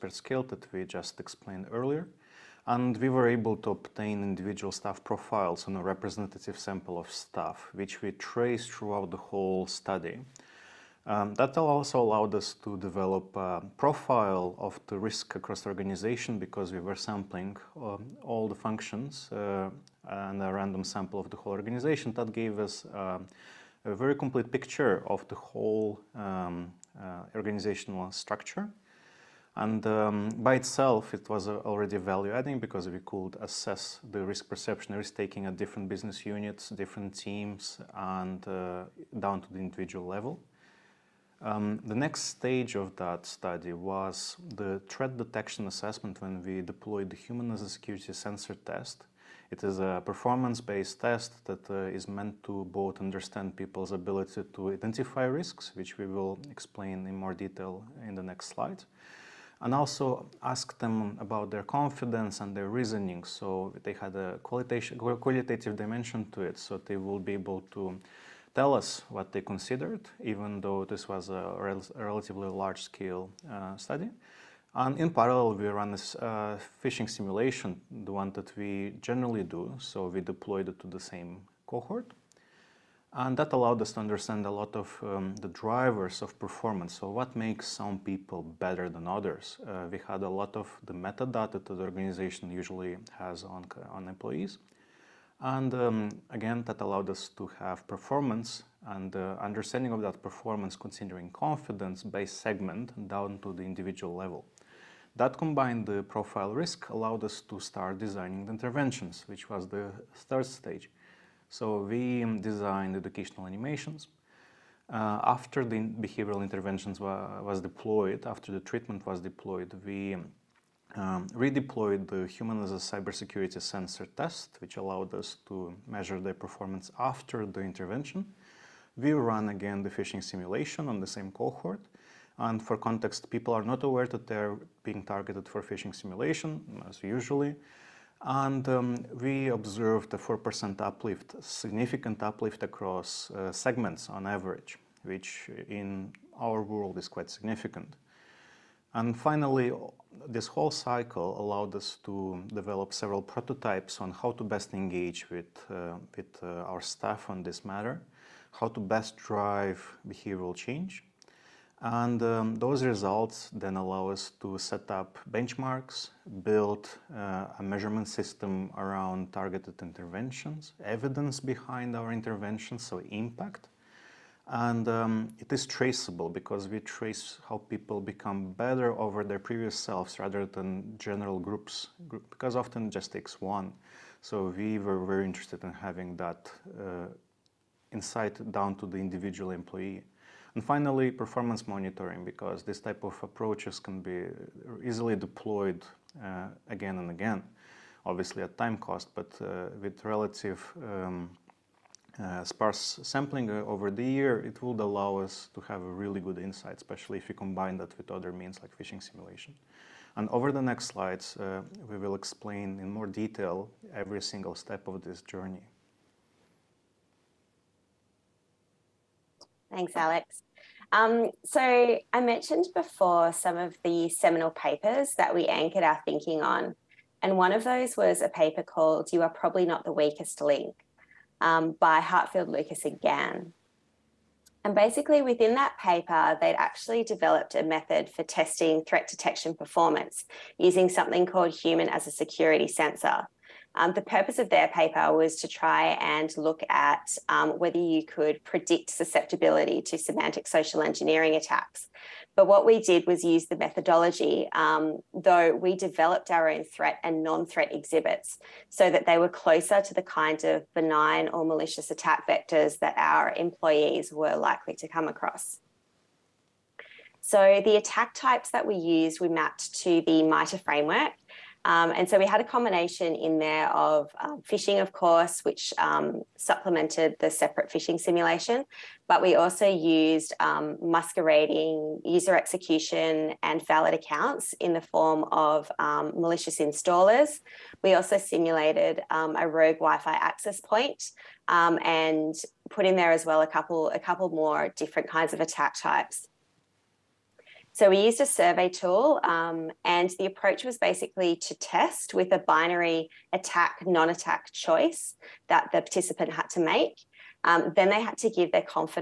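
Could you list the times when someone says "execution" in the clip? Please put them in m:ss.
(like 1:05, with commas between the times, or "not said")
4:42.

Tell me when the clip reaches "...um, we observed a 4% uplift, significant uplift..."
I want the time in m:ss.
2:18.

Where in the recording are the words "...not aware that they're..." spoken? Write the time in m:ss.
2:13.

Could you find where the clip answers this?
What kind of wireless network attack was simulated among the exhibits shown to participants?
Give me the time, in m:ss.
4:49.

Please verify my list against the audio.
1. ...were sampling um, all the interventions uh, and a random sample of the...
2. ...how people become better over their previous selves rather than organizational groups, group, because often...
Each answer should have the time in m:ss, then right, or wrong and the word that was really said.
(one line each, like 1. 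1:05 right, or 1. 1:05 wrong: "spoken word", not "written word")
1. 0:16 wrong: "functions", not "interventions"
2. 2:57 wrong: "general", not "organizational".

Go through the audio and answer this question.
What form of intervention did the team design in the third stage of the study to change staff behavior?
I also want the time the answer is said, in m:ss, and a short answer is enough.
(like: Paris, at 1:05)
educational animations, at 1:52.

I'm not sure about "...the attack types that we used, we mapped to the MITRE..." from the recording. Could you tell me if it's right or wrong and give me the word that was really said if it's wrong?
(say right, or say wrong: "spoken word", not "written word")
right.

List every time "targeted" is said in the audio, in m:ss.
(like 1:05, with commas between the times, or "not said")
2:15, 2:49.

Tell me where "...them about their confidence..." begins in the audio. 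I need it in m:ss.
1:00.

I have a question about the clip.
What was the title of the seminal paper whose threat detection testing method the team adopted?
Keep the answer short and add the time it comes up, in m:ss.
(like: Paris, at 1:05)
You Are Probably Not the Weakest Link, at 3:49.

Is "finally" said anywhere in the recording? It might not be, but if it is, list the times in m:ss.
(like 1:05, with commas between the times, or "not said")
2:29, 3:10.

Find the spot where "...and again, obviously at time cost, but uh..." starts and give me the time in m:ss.
3:16.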